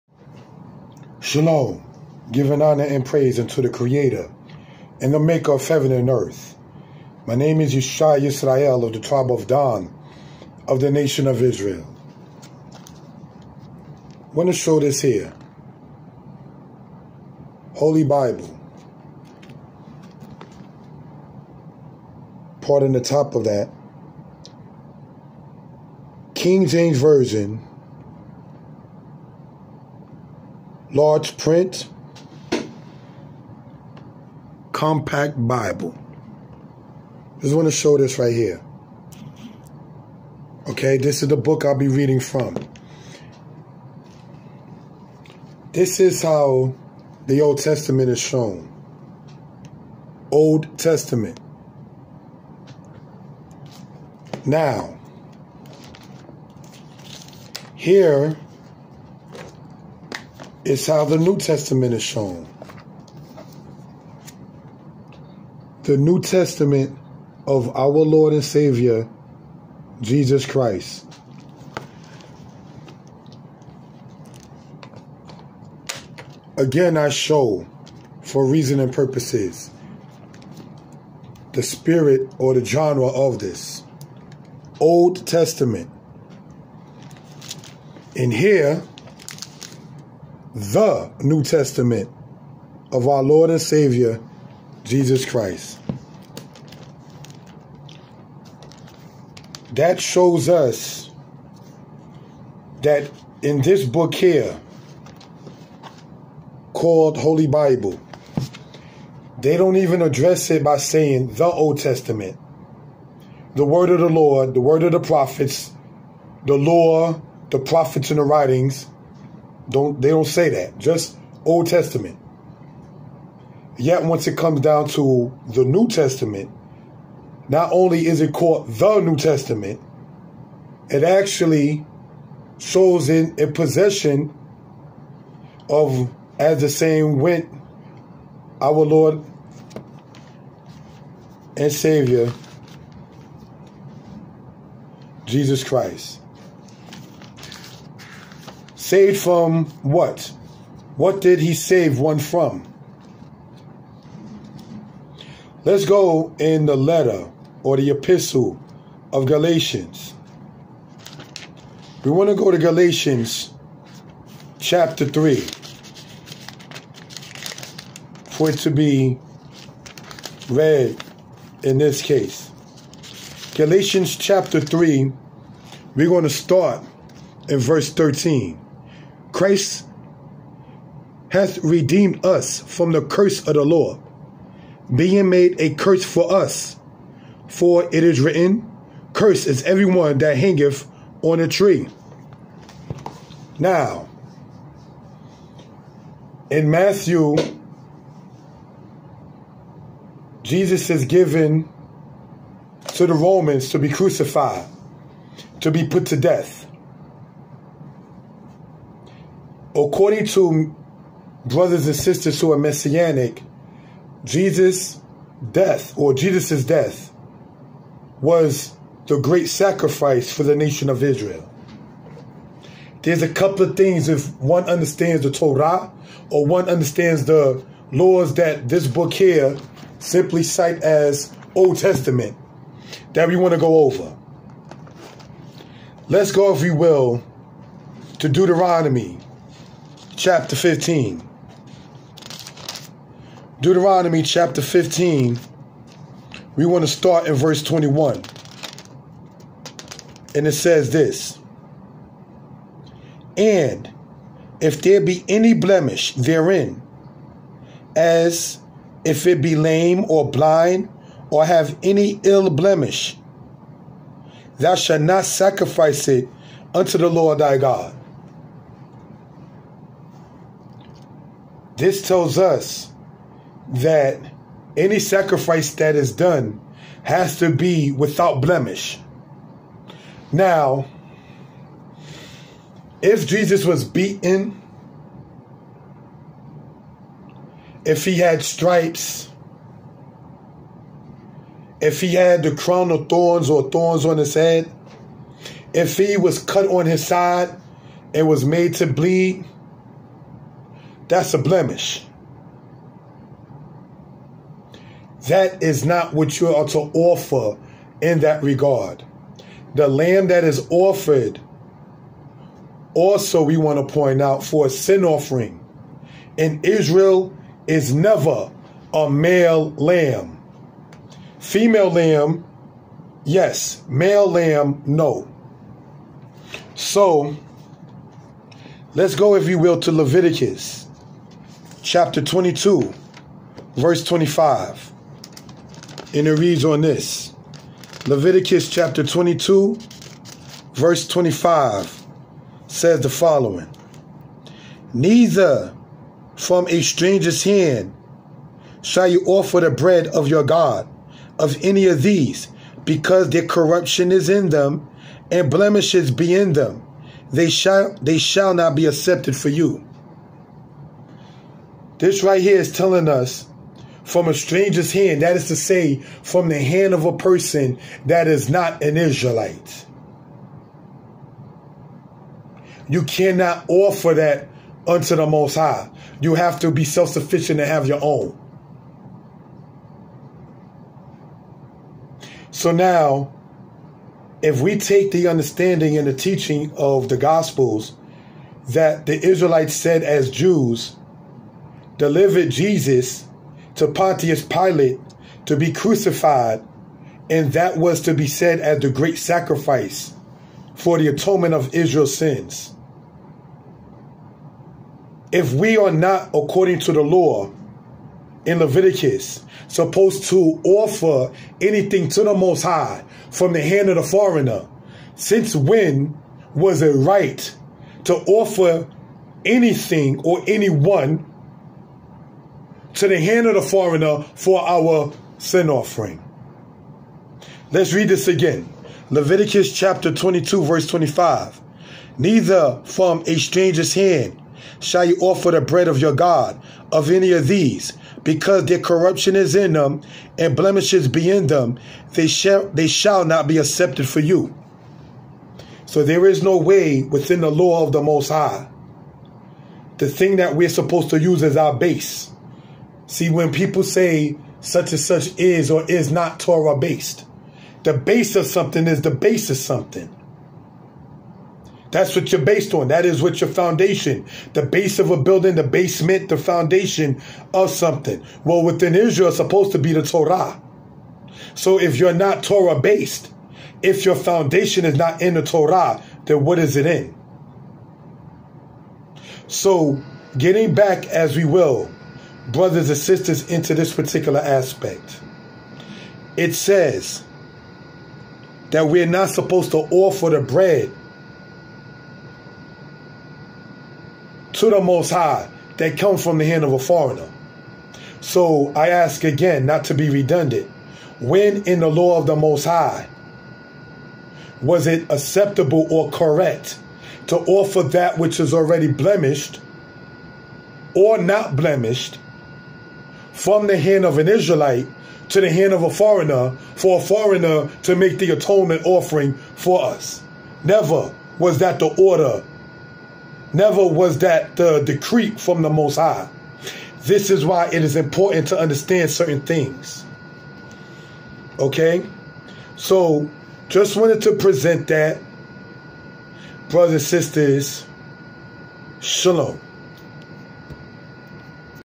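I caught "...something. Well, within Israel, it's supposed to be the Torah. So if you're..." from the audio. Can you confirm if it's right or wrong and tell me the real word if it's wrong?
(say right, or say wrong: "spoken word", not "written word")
right.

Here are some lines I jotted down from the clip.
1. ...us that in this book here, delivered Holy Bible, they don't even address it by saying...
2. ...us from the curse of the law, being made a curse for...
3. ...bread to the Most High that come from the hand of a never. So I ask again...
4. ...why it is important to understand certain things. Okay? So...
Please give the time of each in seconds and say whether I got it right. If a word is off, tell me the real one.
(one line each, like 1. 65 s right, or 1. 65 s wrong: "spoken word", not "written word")
1. 100 s wrong: "called", not "delivered"
2. 182 s right
3. 490 s wrong: "foreigner", not "never"
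4. 527 s right.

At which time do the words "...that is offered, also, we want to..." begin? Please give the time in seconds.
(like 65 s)
310 s.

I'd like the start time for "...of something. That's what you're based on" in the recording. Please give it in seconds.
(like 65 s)
459 s.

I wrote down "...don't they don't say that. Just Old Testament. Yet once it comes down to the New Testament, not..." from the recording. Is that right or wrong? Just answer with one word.
right.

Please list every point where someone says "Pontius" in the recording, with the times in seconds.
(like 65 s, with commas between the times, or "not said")
393 s.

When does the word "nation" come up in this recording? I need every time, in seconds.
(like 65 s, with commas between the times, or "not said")
10 s, 220 s.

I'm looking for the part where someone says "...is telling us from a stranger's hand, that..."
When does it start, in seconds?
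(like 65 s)
362 s.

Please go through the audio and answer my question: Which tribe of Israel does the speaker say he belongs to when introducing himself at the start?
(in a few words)
Dan.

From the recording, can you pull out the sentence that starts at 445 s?
So there is no way within the law of the Most High.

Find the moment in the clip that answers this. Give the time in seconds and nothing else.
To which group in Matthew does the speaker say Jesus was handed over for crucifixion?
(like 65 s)
203 s.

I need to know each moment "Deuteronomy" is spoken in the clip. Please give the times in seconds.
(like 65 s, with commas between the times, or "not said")
238 s, 243 s.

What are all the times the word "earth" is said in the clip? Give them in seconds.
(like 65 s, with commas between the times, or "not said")
6 s.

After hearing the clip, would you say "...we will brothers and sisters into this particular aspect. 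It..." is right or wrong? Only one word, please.
right.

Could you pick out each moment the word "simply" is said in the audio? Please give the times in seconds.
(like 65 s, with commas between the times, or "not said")
229 s.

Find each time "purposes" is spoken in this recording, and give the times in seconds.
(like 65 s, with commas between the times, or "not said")
78 s.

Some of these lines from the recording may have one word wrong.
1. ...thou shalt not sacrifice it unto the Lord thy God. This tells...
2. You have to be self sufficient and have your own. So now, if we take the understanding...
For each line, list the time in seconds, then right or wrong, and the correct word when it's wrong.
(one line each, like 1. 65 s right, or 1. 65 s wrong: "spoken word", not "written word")
1. 264 s right
2. 376 s right.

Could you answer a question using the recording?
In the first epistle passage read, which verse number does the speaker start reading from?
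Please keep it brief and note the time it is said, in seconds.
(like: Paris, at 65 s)
13, at 177 s.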